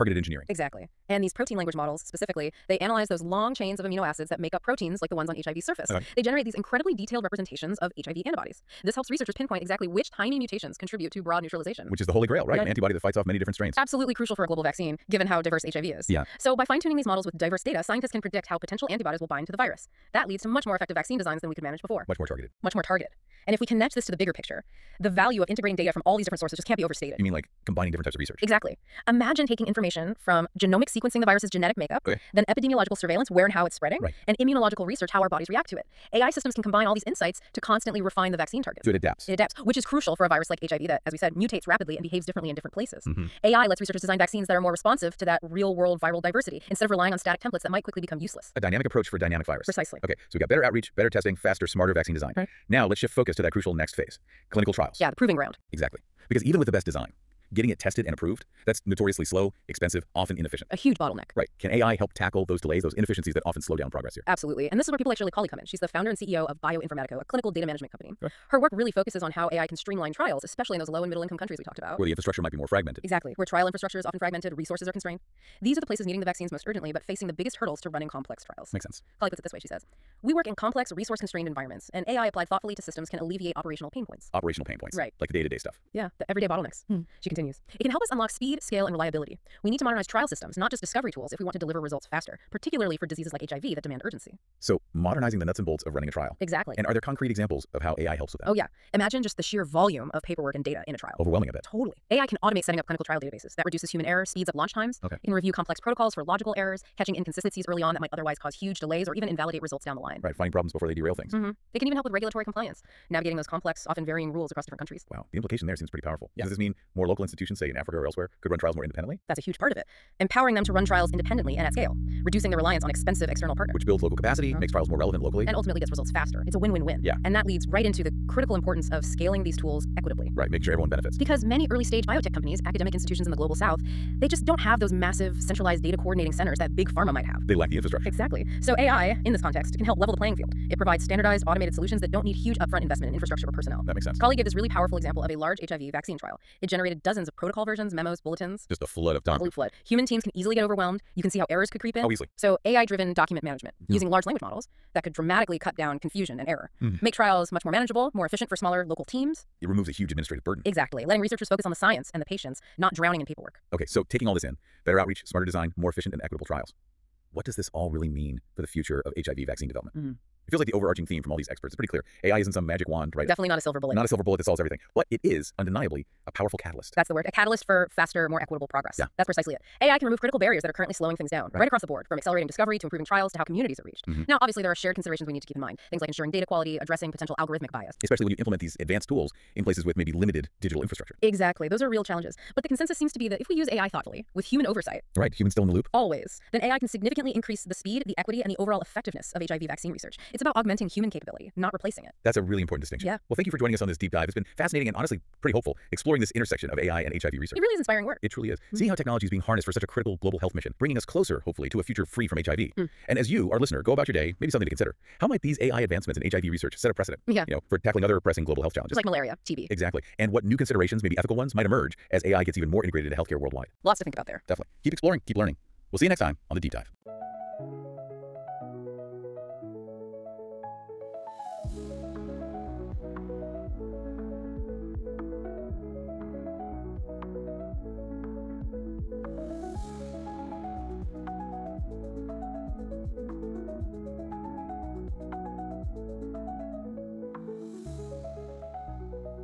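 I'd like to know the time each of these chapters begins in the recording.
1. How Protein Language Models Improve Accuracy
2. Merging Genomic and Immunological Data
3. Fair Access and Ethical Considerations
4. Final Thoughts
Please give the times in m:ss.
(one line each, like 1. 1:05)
1. 0:36
2. 1:29
3. 2:59
4. 3:39.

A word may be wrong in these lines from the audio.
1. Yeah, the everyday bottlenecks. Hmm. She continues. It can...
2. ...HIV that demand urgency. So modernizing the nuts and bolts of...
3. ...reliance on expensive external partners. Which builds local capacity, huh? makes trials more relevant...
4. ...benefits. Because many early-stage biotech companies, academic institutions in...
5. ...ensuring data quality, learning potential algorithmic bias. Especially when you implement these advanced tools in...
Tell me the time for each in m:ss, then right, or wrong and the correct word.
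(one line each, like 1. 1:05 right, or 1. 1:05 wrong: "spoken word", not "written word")
1. 1:25 right
2. 1:33 right
3. 2:02 right
4. 2:10 right
5. 3:06 wrong: "addressing", not "learning".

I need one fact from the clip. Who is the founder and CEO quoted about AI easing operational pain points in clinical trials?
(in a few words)
Shirley Collie.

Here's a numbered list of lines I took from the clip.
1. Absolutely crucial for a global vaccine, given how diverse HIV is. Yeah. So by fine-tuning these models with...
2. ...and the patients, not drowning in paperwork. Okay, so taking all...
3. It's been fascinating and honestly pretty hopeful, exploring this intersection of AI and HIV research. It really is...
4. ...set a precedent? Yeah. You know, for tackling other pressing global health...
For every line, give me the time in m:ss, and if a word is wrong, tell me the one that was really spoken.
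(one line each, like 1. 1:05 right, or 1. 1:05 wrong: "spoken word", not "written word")
1. 0:13 right
2. 2:42 right
3. 3:24 right
4. 3:36 right.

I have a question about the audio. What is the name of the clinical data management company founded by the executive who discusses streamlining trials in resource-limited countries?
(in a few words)
Bioinformatico.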